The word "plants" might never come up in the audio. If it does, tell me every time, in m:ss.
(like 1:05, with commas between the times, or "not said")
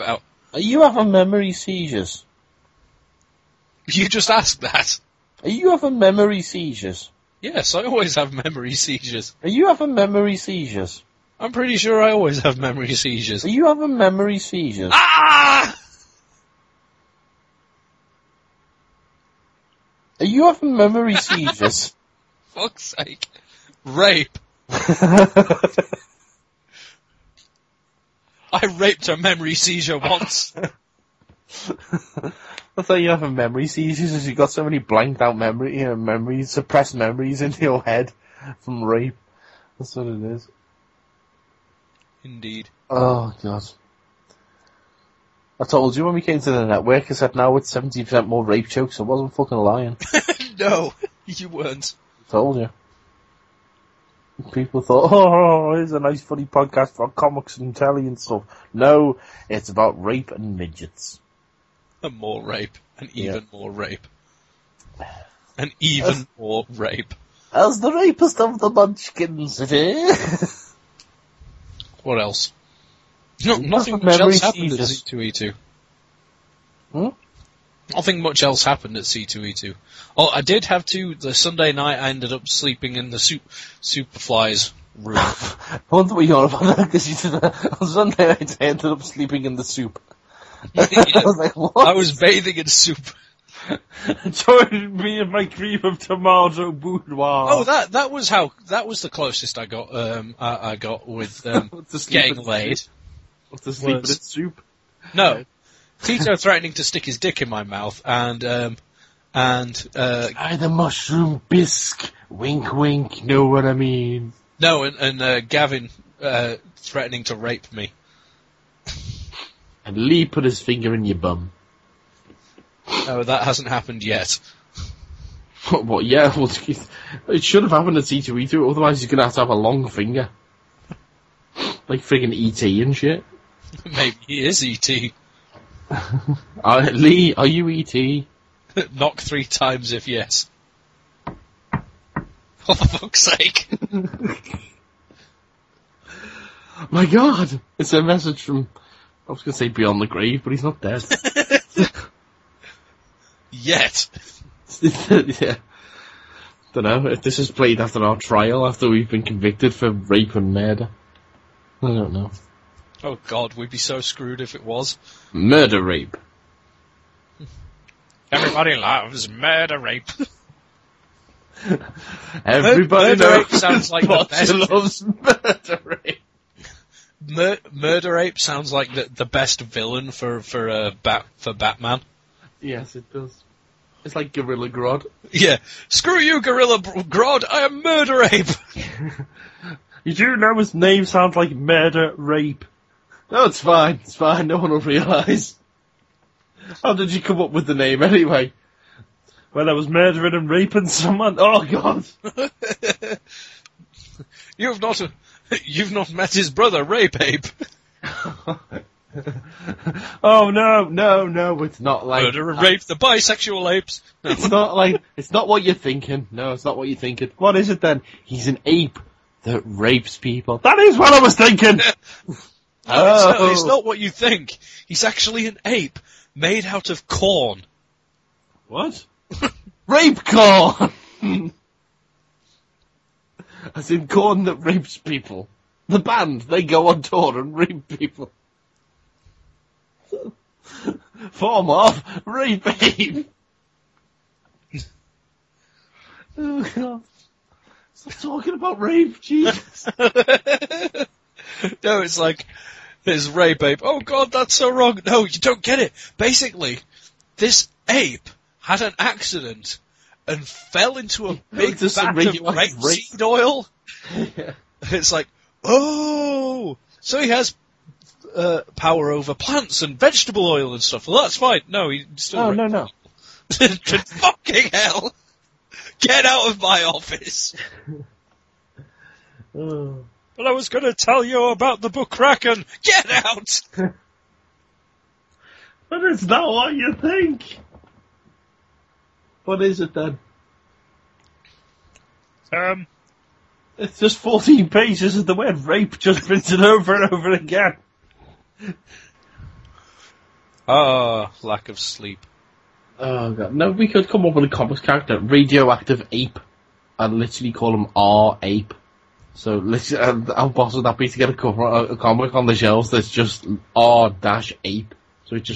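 4:29.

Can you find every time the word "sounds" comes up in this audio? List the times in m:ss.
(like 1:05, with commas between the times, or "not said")
2:53, 2:58, 3:11.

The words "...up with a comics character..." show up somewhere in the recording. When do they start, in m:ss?
5:04.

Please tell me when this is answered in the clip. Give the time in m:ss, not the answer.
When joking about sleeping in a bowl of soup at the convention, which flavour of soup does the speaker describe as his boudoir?
1:35.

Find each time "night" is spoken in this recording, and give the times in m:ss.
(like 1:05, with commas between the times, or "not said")
1:21, 1:28.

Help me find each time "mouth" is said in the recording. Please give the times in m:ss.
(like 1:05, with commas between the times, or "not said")
1:47.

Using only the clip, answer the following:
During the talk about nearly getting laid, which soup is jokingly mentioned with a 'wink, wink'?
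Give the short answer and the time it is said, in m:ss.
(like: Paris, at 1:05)
Mushroom bisque, at 1:50.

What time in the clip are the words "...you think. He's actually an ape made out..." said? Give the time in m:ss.
3:43.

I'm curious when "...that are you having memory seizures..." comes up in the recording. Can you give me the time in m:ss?
0:04.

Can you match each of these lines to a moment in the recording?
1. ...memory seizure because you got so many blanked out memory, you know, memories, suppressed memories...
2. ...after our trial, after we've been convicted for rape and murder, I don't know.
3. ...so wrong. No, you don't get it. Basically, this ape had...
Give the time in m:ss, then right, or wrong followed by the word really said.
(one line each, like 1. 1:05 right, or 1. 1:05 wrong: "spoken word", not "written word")
1. 0:33 right
2. 2:37 right
3. 4:14 right.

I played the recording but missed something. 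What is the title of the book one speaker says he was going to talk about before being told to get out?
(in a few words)
Kraken.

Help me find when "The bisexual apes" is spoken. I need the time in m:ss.
3:32.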